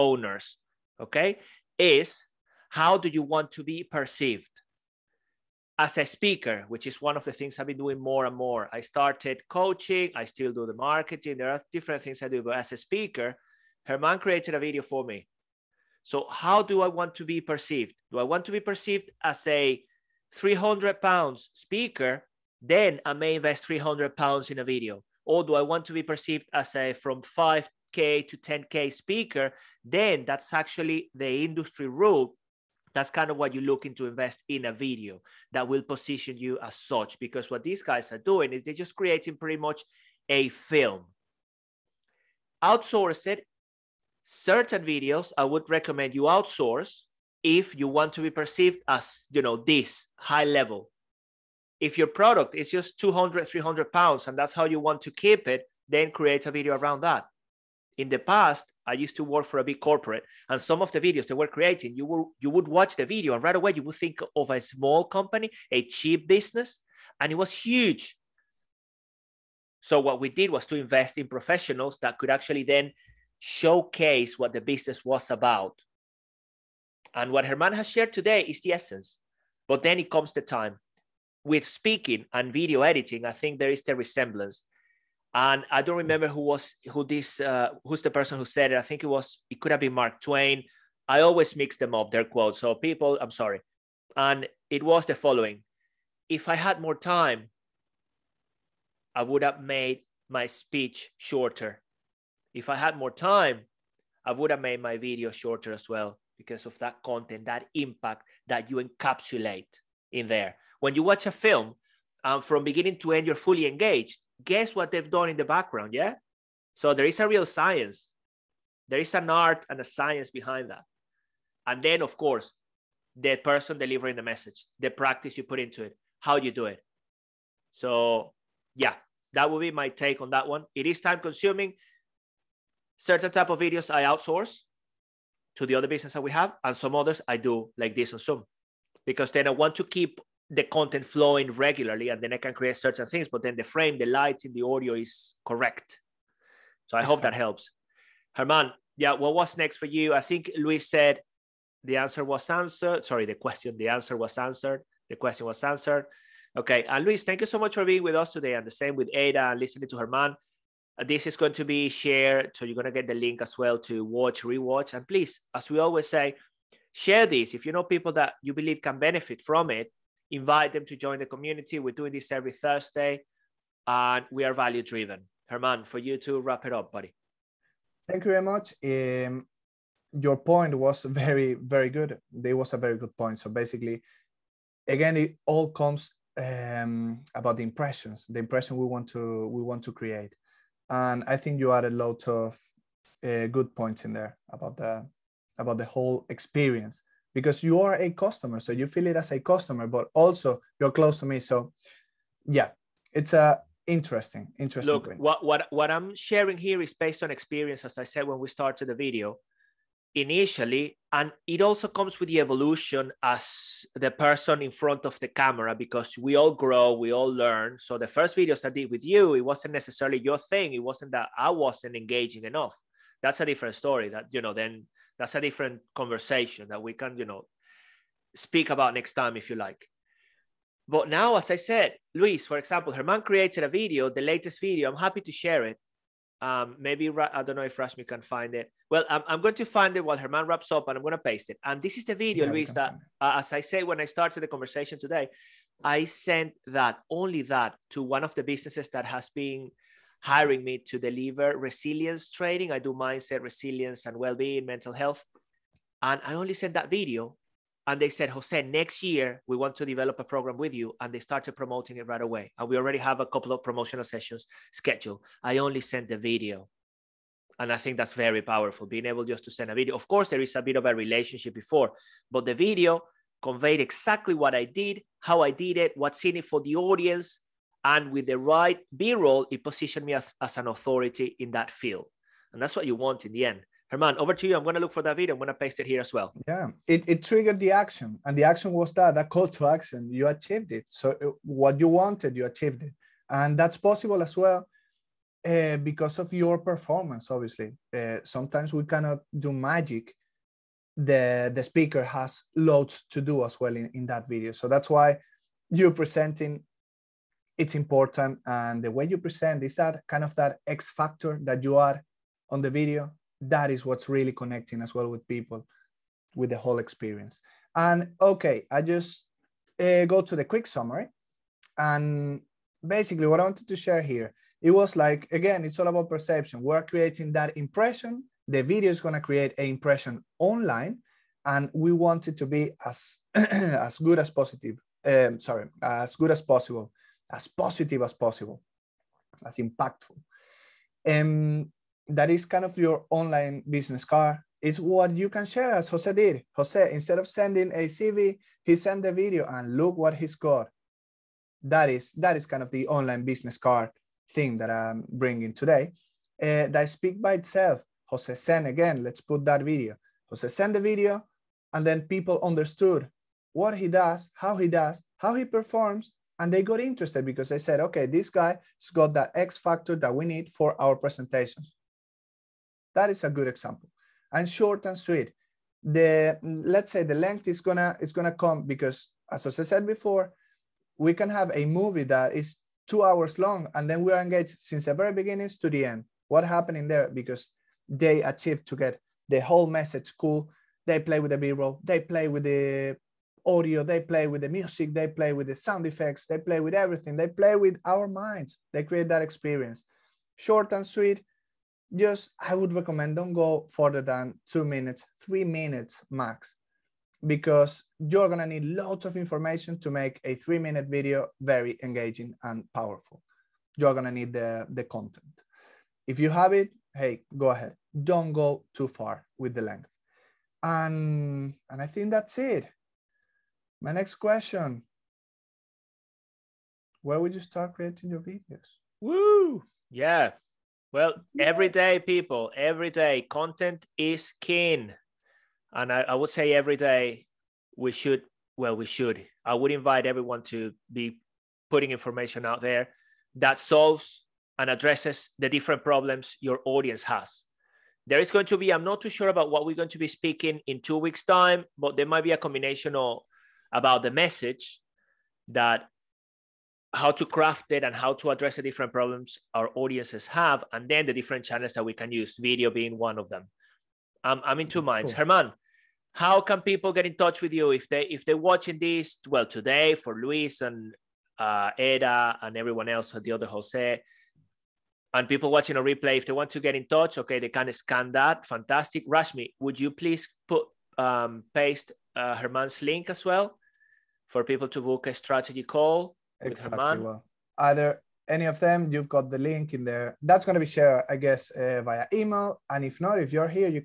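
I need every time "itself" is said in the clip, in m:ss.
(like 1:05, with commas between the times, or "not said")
5:57.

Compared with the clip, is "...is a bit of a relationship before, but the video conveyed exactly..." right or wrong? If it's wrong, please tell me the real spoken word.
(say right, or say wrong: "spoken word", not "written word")
right.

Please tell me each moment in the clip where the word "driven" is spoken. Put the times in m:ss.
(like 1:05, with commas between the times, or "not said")
2:54.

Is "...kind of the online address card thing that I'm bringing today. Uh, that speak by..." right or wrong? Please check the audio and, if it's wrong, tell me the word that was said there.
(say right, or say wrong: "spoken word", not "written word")
wrong: "business", not "address".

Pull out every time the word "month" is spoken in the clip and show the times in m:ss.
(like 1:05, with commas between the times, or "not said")
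not said.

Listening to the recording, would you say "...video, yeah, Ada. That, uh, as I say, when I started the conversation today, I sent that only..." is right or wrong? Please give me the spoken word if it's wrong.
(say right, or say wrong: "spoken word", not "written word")
wrong: "Luis", not "Ada".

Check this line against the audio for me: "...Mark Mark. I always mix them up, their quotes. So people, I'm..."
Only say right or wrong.
wrong.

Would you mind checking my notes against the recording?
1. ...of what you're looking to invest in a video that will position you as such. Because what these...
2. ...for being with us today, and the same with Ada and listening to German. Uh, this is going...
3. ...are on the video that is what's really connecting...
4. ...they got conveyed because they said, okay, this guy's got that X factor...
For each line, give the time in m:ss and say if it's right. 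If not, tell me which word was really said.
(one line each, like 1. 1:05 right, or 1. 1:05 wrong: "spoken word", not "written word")
1. 0:33 right
2. 2:37 right
3. 5:11 right
4. 6:06 wrong: "interested", not "conveyed".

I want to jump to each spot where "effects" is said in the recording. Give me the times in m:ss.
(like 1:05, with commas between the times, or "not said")
6:35.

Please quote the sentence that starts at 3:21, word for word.
So, yeah, it's a uh, interesting, interesting.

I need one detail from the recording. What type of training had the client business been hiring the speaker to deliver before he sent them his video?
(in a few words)
Resilience training.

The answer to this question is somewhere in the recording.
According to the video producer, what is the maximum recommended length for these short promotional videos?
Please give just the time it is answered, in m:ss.
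6:45.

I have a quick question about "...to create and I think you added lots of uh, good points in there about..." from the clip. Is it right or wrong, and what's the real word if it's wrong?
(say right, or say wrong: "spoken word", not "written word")
right.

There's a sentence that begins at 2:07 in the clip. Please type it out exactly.
So, yeah, that would be my take on that one.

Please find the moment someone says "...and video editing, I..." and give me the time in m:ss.
1:22.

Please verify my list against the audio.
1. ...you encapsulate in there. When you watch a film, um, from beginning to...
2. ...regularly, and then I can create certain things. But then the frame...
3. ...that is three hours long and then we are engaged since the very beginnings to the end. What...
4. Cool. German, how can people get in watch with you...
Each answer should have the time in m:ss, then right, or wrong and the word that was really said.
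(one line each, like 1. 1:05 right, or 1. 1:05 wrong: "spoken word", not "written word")
1. 1:48 right
2. 2:21 right
3. 6:22 wrong: "two", not "three"
4. 7:45 wrong: "touch", not "watch".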